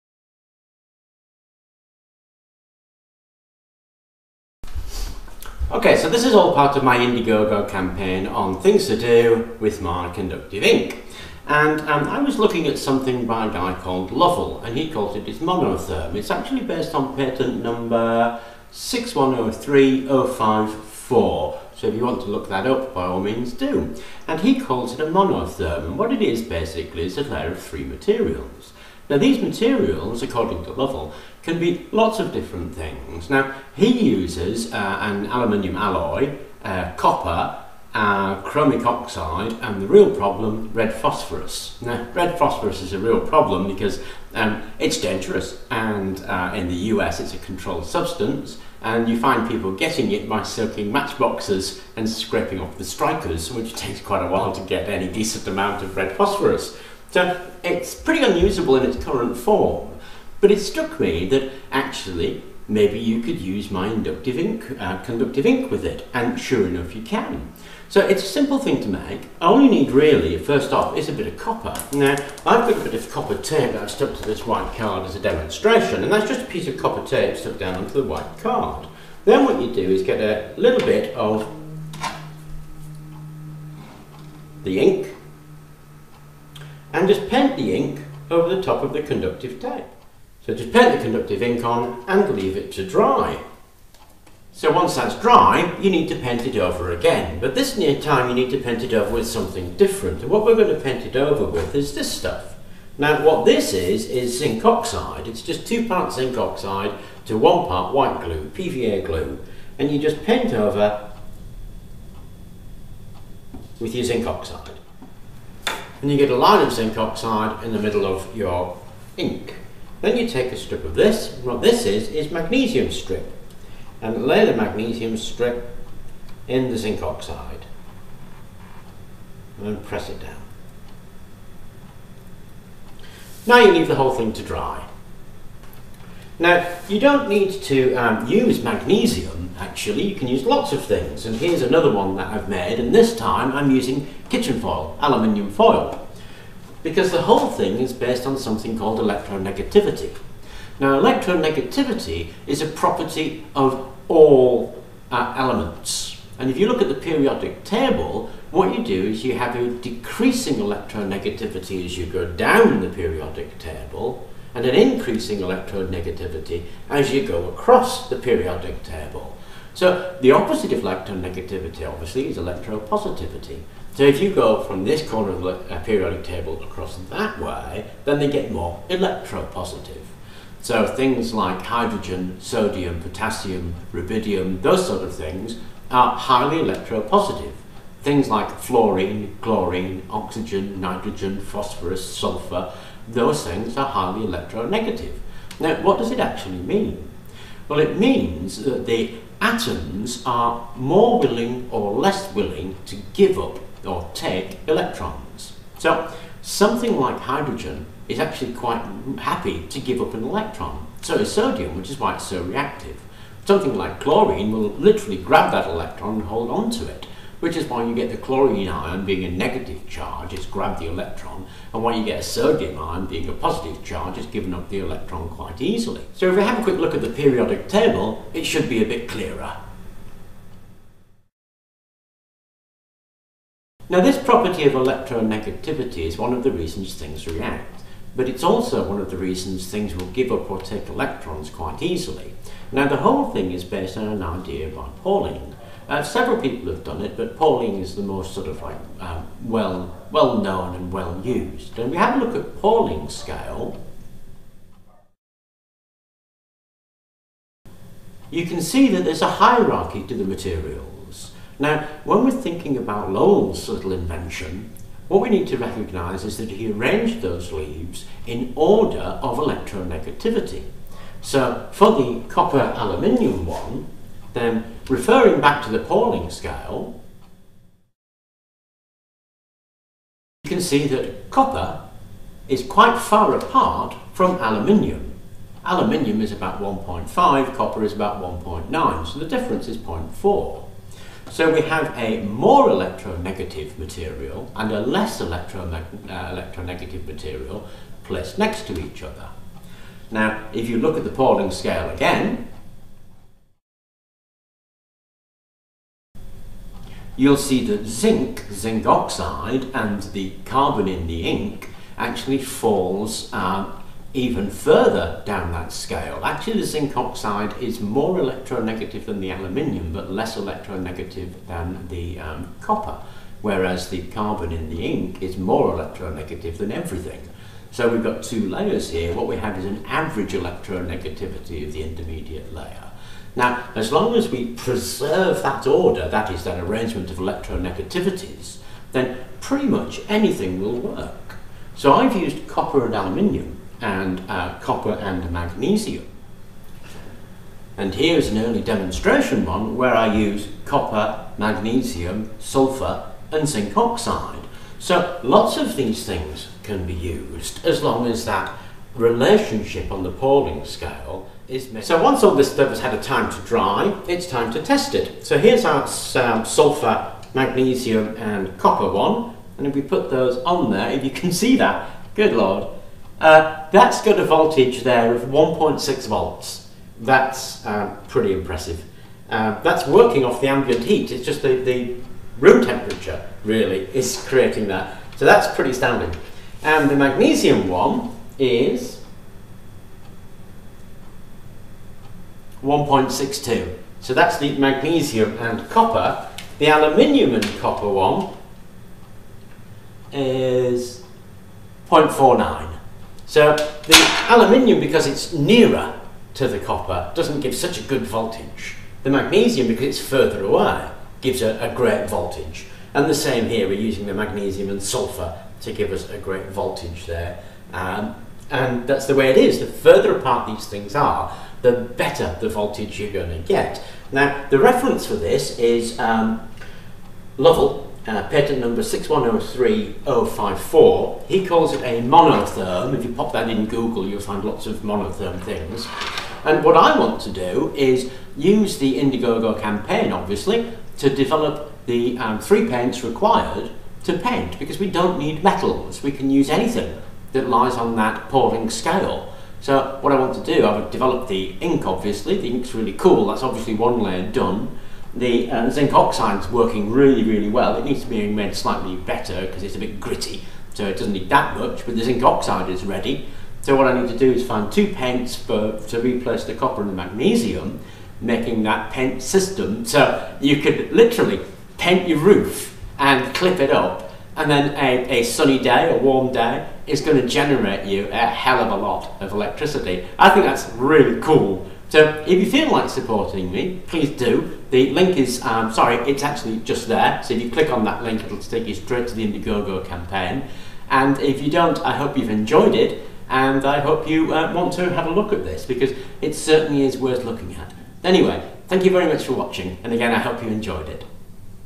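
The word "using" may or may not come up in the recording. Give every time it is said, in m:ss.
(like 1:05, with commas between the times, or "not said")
2:23, 6:53.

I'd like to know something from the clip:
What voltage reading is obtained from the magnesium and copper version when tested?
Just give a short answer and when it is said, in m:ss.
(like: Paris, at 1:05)
1.62 volts, at 6:32.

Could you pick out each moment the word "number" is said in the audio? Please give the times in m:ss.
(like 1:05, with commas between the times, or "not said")
0:17, 7:08.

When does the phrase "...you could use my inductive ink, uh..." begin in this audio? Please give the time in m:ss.
1:02.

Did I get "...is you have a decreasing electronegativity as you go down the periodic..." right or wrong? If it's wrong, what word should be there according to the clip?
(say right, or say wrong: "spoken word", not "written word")
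right.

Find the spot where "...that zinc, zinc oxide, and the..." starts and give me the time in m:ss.
5:07.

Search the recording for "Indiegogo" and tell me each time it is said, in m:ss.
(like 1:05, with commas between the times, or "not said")
0:06, 7:18, 8:09.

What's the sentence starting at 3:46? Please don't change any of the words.
So if we have a quick look at the periodic table, it should be a bit clearer.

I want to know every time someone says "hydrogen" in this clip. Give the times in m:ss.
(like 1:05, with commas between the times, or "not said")
3:01, 3:27.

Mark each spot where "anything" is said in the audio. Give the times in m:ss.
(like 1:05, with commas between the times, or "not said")
5:40, 7:26.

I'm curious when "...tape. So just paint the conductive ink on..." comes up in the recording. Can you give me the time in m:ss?
1:29.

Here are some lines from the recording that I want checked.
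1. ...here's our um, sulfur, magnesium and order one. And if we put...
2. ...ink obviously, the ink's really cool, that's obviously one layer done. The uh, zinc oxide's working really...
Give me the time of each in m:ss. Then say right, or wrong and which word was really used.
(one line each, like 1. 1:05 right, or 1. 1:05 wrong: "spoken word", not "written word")
1. 6:05 wrong: "copper", not "order"
2. 7:31 right.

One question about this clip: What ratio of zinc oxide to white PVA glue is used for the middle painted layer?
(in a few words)
2 to 1.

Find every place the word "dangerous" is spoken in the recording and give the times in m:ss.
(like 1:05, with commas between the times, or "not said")
0:45.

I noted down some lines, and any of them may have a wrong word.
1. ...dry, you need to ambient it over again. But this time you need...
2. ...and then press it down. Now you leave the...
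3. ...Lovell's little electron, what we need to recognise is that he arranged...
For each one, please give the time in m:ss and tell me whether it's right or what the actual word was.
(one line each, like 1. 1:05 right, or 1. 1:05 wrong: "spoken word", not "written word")
1. 1:35 wrong: "paint", not "ambient"
2. 2:09 right
3. 4:23 wrong: "invention", not "electron".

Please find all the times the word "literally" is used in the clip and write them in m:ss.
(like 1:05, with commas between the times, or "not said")
3:34, 7:50.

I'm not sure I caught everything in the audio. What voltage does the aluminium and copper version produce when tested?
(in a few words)
0.49 volts.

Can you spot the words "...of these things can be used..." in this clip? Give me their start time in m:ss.
5:55.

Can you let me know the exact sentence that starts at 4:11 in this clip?
And we have a look at Pauling's scale.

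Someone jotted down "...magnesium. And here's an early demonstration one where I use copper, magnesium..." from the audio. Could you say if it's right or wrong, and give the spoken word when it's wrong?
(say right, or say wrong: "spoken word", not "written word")
right.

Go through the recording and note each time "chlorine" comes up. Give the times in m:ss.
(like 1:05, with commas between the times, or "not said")
3:09, 3:34, 3:38.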